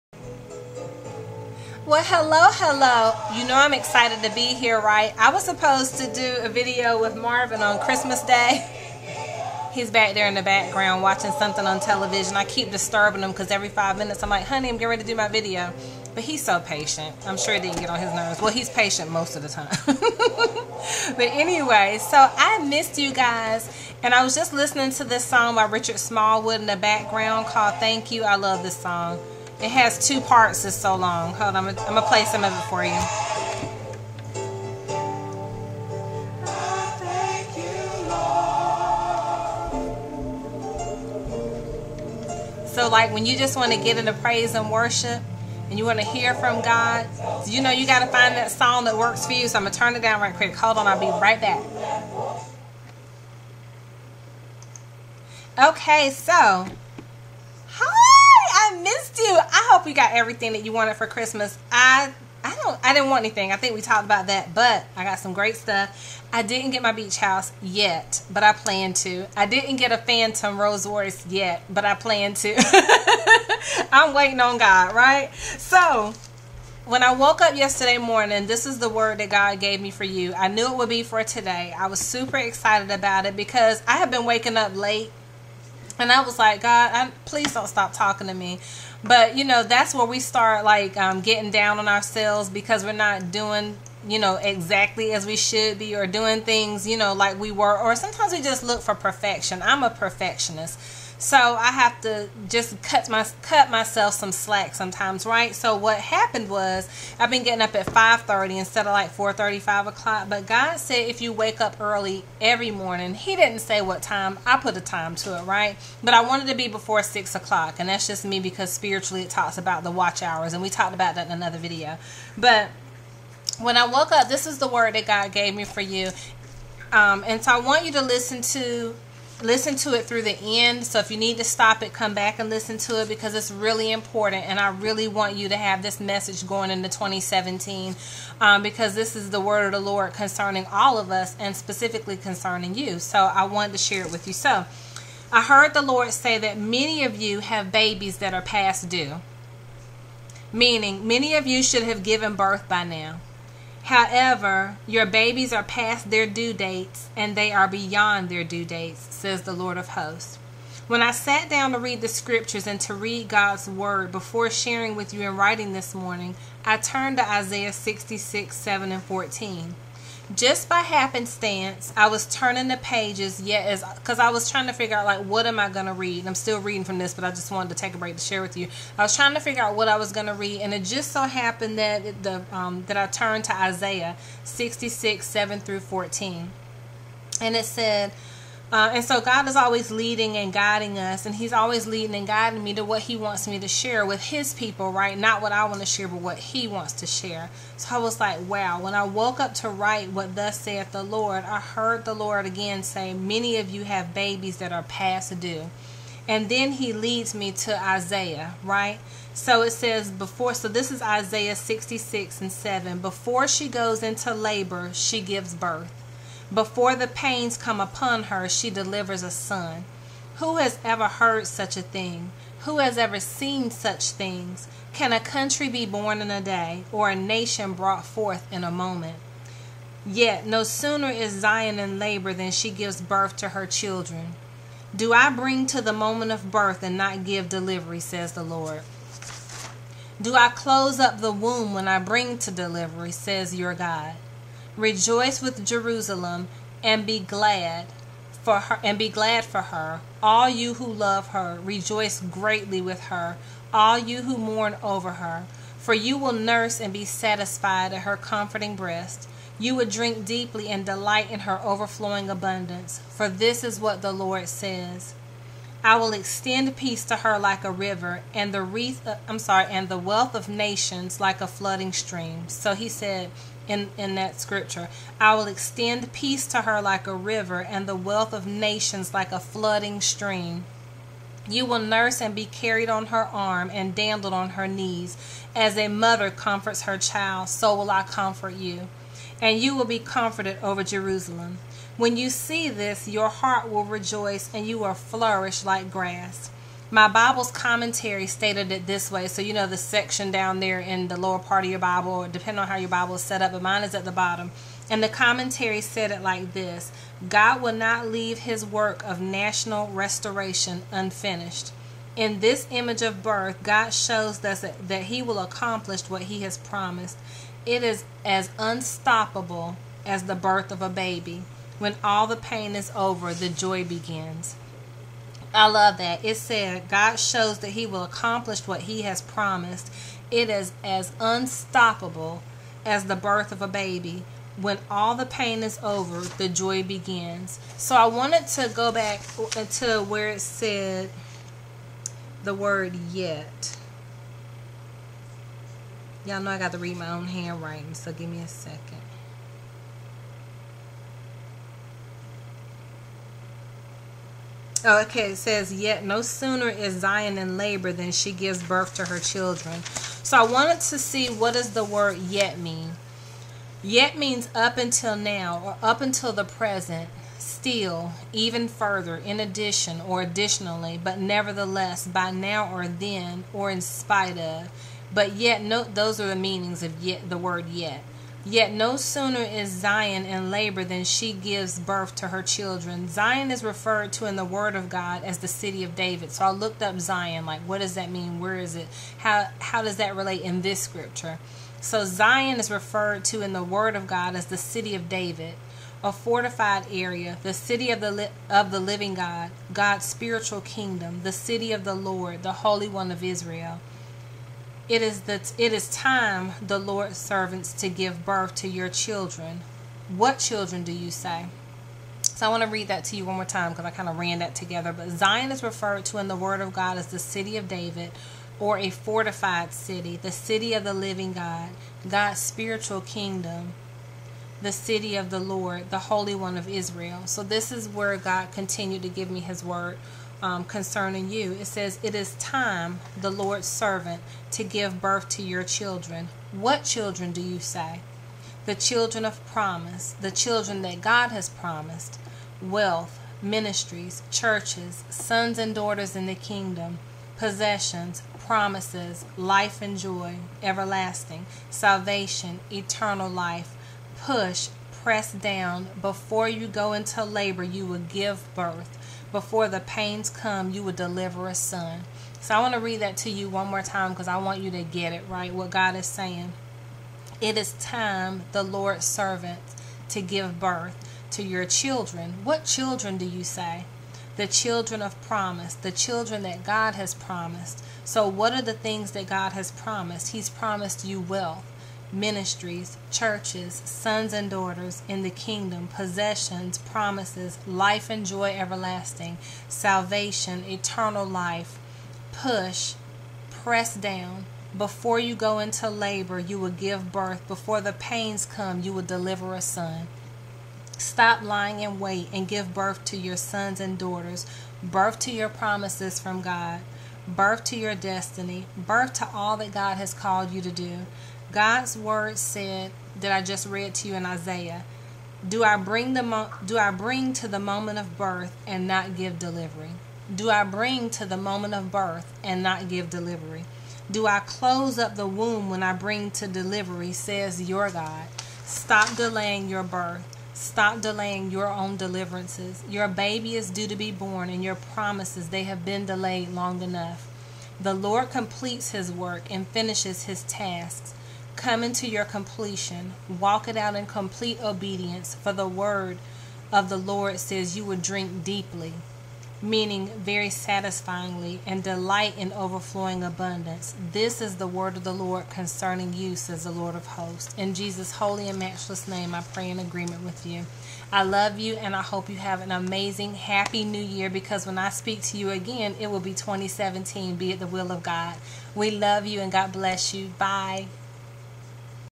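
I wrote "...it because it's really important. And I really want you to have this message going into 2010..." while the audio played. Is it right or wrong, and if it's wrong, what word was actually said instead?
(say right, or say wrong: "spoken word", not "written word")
wrong: "2017", not "2010".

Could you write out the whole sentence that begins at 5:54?
okay, it says, Yet no sooner is Zion in labor than she gives birth to her children.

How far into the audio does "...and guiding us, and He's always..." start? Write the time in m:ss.
3:10.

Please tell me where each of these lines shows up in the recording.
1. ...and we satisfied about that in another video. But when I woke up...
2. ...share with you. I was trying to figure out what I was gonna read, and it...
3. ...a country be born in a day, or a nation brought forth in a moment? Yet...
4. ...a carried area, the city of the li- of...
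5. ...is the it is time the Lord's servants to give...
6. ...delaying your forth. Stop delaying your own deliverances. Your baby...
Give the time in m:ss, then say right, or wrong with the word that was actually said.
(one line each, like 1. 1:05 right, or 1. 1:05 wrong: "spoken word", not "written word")
1. 2:00 wrong: "talked", not "satisfied"
2. 2:58 right
3. 3:45 right
4. 6:36 wrong: "fortified", not "carried"
5. 6:45 right
6. 8:49 wrong: "birth", not "forth".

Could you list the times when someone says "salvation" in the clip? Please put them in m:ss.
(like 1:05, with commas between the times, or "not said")
7:31, 8:09.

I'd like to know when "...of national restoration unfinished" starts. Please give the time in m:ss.
5:09.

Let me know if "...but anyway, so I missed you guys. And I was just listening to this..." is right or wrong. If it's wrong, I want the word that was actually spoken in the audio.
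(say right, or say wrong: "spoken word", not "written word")
right.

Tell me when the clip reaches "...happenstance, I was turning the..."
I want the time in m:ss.
2:50.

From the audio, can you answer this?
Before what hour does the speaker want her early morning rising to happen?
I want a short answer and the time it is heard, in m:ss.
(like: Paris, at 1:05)
6 o'clock, at 1:57.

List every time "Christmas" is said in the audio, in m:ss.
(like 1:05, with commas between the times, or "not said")
0:07, 1:01.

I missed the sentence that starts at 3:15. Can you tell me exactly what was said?
Not what I want to share, but what He wants to share.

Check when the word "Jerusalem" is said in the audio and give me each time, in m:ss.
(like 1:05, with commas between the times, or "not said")
4:05, 4:50.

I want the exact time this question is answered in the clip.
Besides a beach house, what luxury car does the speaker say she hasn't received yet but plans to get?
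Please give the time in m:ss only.
1:09.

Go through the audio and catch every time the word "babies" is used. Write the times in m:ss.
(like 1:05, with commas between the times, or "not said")
2:27, 2:35, 3:24.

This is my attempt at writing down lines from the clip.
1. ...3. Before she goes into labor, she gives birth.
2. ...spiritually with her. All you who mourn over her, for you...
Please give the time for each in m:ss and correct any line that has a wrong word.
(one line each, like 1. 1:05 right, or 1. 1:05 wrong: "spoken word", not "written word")
1. 3:32 wrong: "7", not "3"
2. 4:12 wrong: "greatly", not "spiritually".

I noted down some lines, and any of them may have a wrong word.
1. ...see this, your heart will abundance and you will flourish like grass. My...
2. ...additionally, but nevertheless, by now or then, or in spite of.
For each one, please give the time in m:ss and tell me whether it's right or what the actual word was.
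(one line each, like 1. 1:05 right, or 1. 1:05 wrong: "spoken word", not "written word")
1. 4:52 wrong: "rejoice", not "abundance"
2. 6:10 right.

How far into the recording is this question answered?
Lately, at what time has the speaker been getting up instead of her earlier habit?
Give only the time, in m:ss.
1:47.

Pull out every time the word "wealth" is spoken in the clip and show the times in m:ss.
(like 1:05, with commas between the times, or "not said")
4:29, 4:37, 7:22, 8:01.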